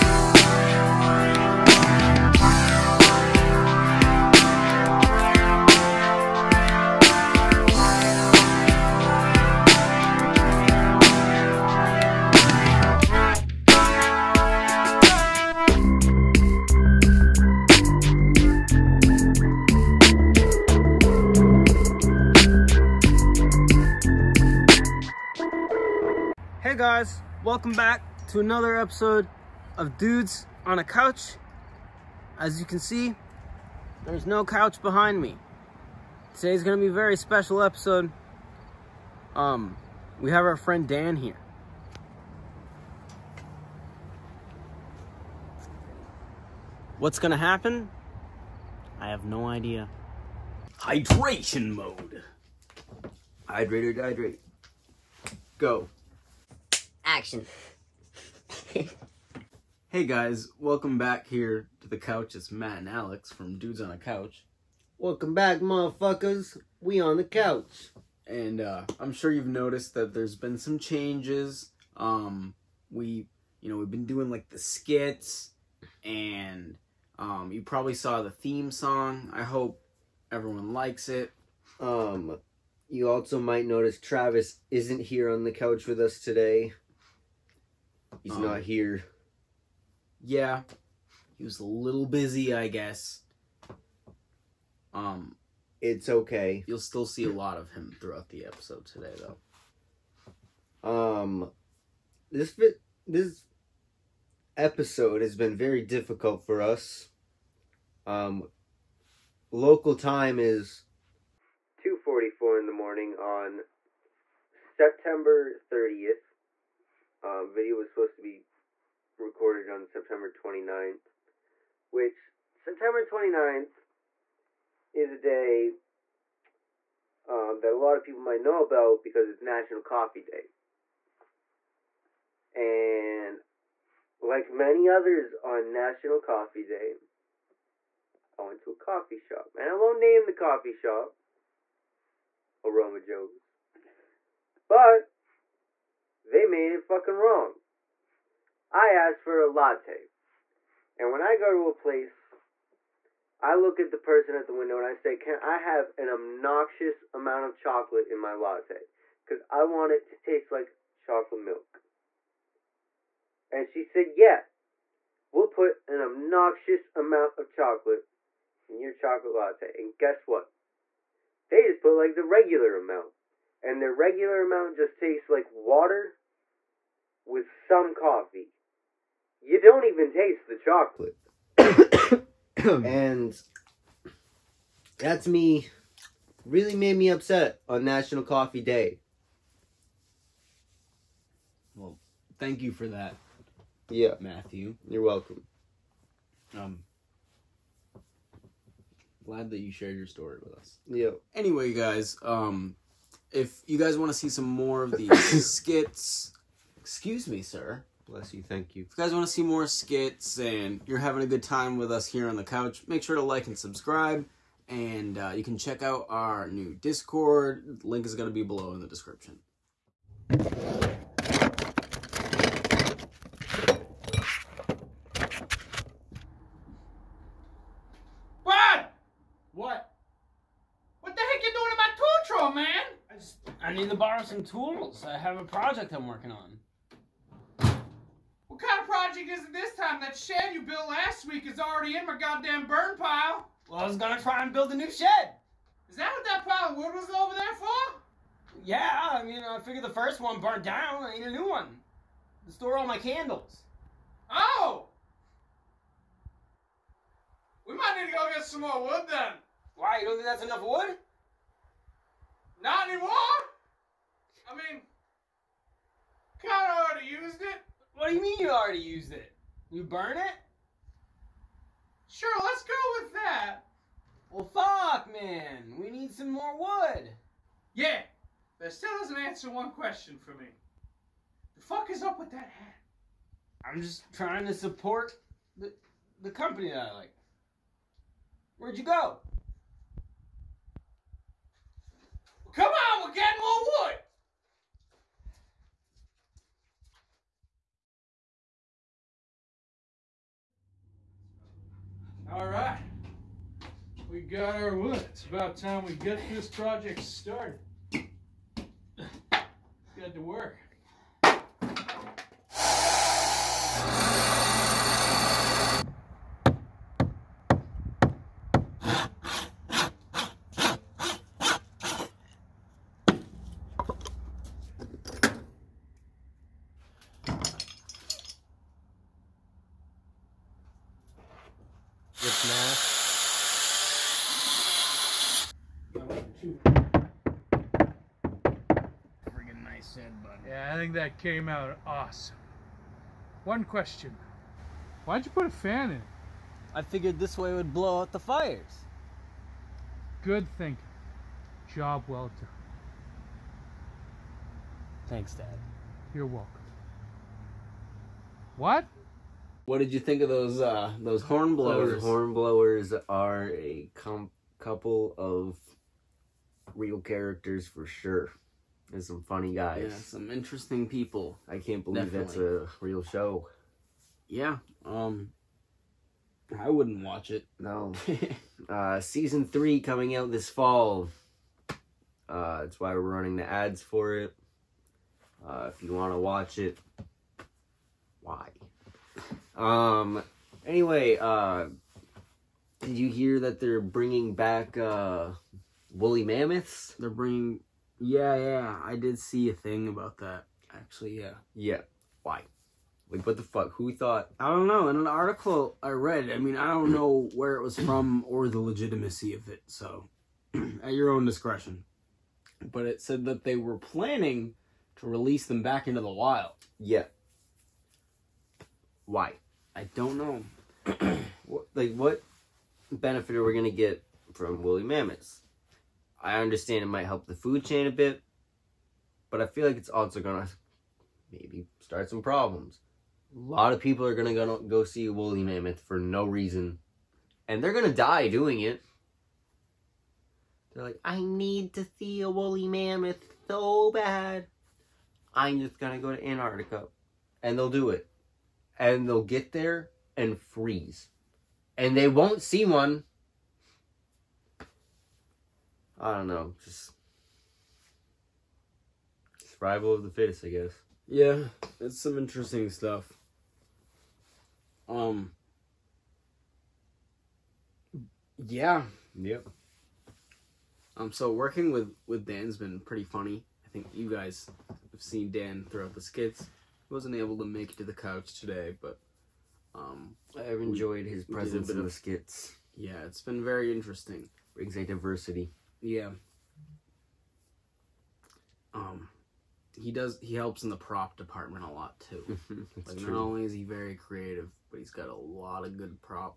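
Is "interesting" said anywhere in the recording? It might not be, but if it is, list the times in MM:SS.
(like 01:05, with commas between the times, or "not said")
06:10, 07:42, 08:03.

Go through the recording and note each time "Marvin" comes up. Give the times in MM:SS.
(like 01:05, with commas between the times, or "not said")
not said.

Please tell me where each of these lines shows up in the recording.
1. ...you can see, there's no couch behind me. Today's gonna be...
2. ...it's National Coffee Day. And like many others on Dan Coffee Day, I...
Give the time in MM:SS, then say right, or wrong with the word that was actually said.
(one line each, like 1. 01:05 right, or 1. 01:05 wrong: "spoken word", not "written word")
1. 00:32 right
2. 02:09 wrong: "National", not "Dan".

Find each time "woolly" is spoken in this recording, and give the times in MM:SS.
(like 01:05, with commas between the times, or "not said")
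06:35, 07:04, 07:15, 07:22.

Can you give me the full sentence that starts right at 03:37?
Link is going to be below in the description.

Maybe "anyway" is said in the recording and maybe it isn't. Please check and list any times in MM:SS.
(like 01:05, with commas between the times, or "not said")
03:21, 06:30.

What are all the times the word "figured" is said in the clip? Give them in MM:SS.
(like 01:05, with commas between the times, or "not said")
04:09, 05:46.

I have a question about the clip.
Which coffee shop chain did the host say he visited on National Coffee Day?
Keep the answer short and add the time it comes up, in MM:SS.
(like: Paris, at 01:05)
Aroma Joe's, at 02:22.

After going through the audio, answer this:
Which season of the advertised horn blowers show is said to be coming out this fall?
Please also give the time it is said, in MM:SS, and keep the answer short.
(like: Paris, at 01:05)
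season 3, at 06:19.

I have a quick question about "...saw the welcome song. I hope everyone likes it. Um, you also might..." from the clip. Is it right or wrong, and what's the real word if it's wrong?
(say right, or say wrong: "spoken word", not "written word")
wrong: "theme", not "welcome".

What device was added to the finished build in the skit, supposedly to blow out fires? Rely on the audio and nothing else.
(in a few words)
a fan.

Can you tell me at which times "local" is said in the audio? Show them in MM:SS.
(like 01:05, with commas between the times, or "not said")
01:49.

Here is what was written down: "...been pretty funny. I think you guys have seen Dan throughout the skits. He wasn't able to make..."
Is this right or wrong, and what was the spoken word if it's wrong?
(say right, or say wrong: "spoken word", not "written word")
right.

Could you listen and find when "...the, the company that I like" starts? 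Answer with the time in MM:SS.
04:45.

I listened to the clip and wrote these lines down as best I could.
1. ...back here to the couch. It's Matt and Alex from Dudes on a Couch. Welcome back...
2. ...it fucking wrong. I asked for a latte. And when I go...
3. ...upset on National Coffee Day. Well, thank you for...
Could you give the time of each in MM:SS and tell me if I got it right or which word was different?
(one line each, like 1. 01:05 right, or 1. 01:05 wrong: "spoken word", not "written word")
1. 01:00 right
2. 02:26 right
3. 03:07 right.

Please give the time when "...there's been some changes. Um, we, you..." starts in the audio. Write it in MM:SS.
01:10.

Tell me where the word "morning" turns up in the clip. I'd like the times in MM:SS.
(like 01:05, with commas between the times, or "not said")
01:52.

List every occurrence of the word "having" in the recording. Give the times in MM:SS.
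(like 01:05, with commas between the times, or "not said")
03:30.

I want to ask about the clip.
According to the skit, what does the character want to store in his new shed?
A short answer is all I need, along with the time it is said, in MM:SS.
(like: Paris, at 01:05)
candles, at 04:12.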